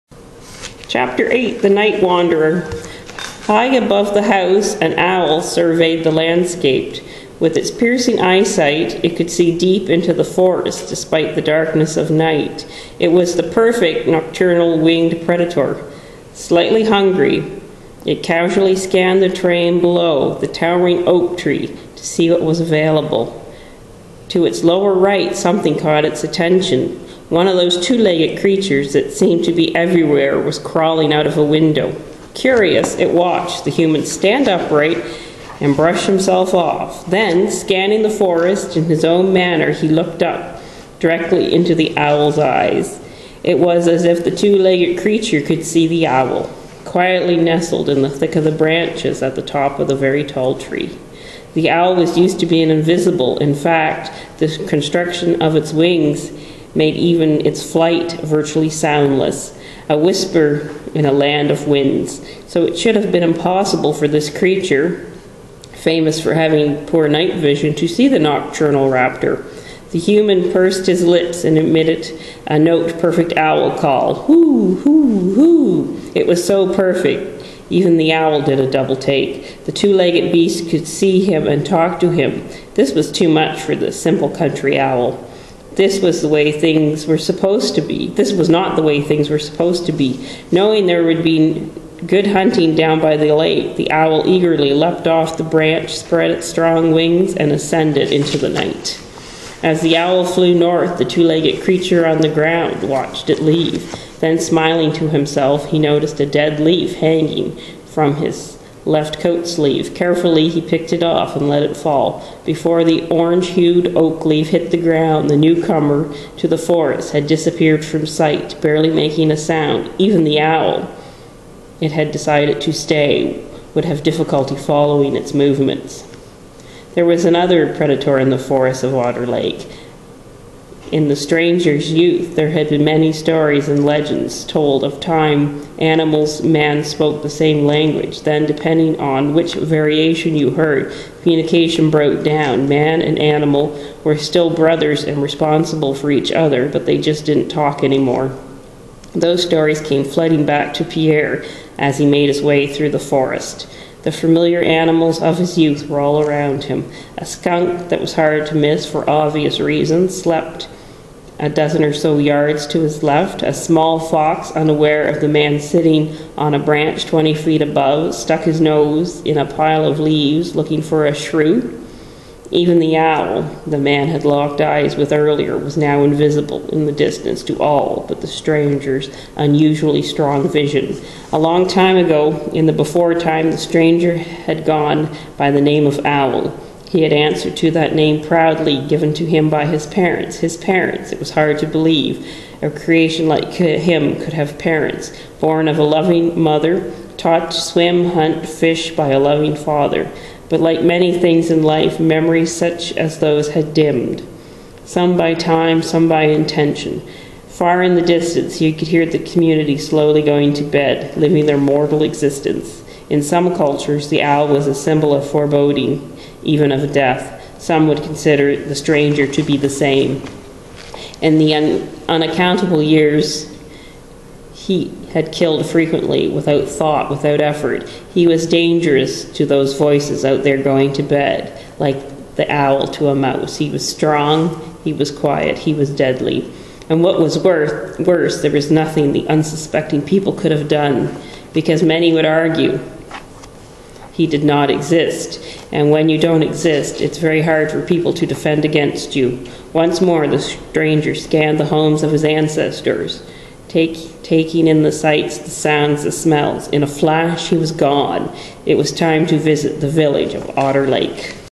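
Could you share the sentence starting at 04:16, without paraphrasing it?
In a flash, he was gone.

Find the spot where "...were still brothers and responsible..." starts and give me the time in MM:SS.
02:24.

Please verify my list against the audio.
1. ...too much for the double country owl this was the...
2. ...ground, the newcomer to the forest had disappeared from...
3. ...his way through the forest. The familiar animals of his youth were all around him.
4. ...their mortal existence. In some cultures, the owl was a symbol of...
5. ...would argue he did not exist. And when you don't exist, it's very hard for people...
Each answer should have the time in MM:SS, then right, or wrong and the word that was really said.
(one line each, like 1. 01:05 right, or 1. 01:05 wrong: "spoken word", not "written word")
1. 01:23 wrong: "simple", not "double"
2. 01:54 right
3. 02:32 right
4. 03:31 right
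5. 04:02 right.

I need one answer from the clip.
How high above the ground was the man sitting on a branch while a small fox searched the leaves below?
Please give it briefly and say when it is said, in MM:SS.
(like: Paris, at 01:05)
20 feet, at 02:47.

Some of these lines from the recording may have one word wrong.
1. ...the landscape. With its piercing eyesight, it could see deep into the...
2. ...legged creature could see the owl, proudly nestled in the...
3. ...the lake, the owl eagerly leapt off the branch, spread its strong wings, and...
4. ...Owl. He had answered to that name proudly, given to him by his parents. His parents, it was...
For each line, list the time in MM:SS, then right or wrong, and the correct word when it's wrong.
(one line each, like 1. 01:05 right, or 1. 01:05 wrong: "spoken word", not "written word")
1. 00:06 right
2. 00:44 wrong: "quietly", not "proudly"
3. 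01:33 right
4. 03:06 right.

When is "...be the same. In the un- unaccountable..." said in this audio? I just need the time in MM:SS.
03:39.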